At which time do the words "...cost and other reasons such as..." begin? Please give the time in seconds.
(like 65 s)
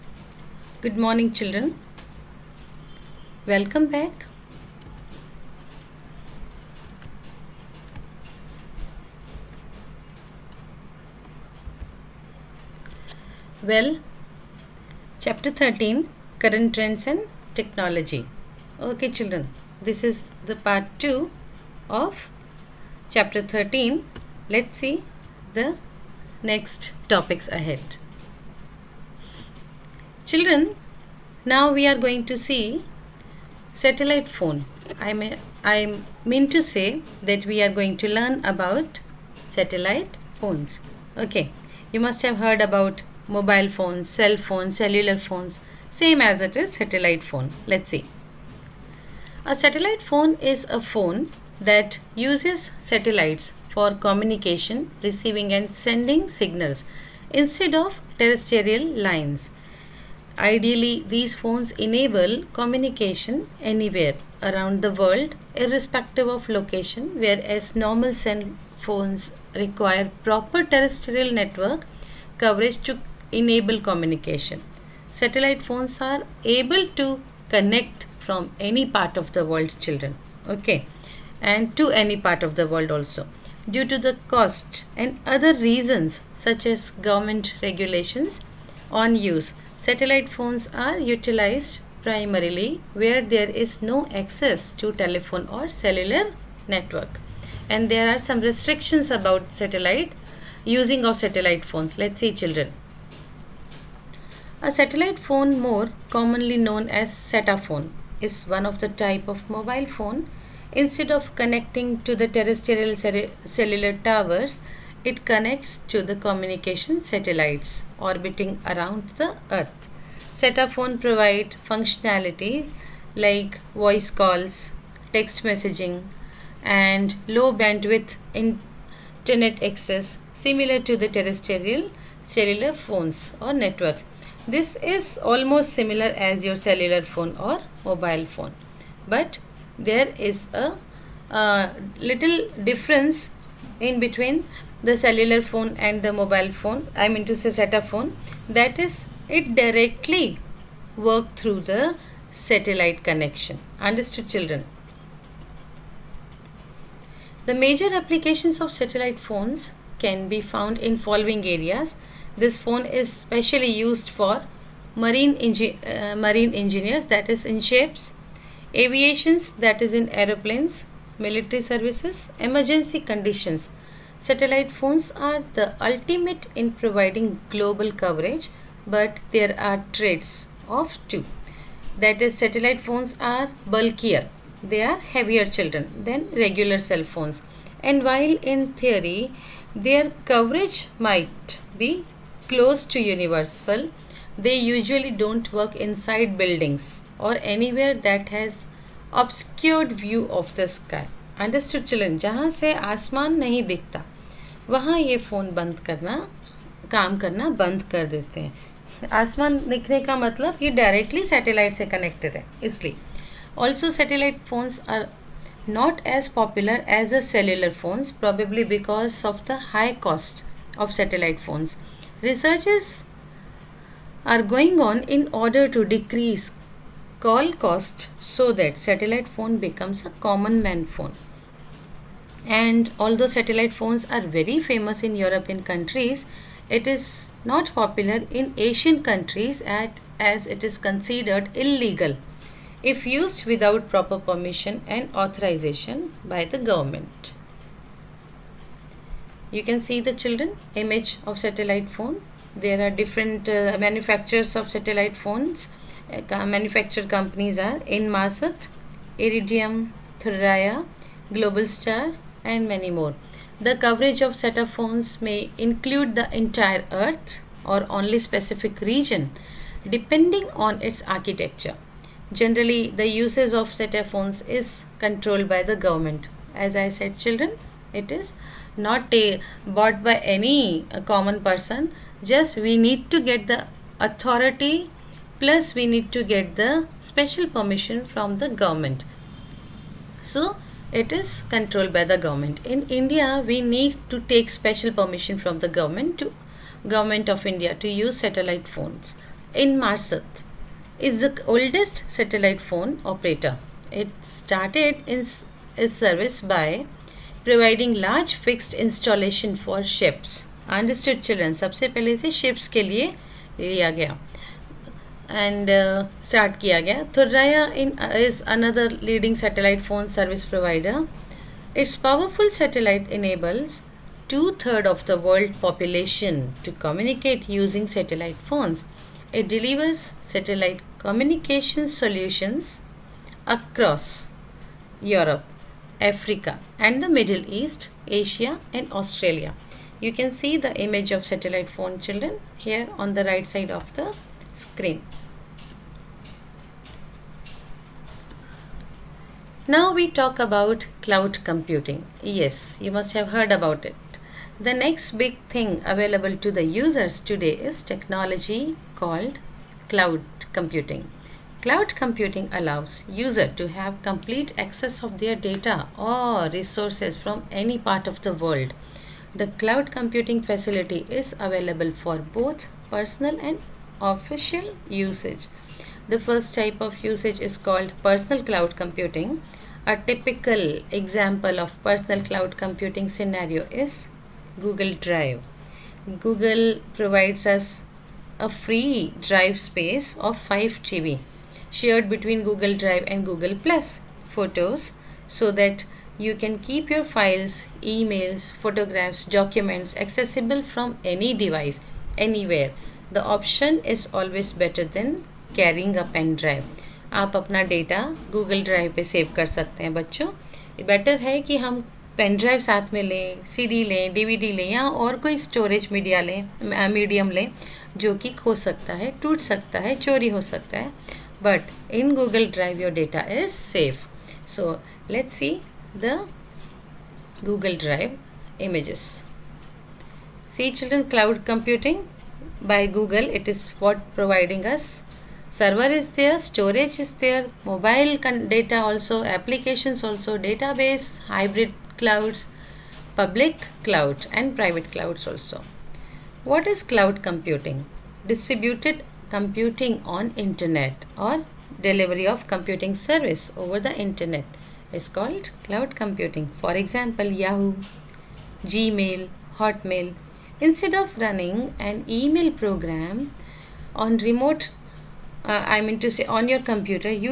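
84 s.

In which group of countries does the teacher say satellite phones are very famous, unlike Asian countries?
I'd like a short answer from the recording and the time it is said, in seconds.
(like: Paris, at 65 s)
European countries, at 235 s.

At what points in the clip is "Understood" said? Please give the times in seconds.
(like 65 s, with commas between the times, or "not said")
153 s, 201 s, 310 s.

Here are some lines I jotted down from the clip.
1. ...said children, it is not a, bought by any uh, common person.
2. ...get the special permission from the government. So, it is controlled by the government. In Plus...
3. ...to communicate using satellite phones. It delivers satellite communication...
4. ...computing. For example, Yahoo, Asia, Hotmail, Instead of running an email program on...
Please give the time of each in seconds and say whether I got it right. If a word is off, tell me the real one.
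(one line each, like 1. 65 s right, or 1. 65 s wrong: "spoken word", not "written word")
1. 276 s right
2. 286 s wrong: "India", not "Plus"
3. 326 s right
4. 455 s wrong: "Gmail", not "Asia".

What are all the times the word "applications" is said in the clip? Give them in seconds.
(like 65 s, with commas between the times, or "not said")
157 s, 439 s.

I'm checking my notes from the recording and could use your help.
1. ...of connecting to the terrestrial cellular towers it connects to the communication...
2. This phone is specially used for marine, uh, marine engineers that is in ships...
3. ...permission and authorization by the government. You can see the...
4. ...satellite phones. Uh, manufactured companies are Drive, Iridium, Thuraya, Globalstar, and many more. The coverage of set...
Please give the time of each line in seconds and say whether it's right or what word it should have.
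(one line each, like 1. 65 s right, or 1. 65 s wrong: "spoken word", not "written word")
1. 111 s right
2. 162 s right
3. 244 s right
4. 254 s wrong: "Inmarsat", not "Drive".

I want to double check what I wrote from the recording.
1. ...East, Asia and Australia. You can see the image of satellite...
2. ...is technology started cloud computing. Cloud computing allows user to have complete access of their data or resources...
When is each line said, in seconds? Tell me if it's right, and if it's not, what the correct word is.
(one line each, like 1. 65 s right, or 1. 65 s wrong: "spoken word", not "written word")
1. 337 s right
2. 357 s wrong: "called", not "started".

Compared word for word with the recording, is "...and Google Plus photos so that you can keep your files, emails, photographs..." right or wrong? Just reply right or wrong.
right.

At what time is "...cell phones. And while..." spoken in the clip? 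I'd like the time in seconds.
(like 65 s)
186 s.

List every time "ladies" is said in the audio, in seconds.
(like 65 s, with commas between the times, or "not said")
not said.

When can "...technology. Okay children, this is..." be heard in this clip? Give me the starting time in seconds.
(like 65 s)
17 s.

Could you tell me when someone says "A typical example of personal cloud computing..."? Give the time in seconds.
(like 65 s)
379 s.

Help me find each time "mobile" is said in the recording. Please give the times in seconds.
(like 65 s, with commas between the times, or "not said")
43 s, 109 s, 137 s, 146 s, 437 s.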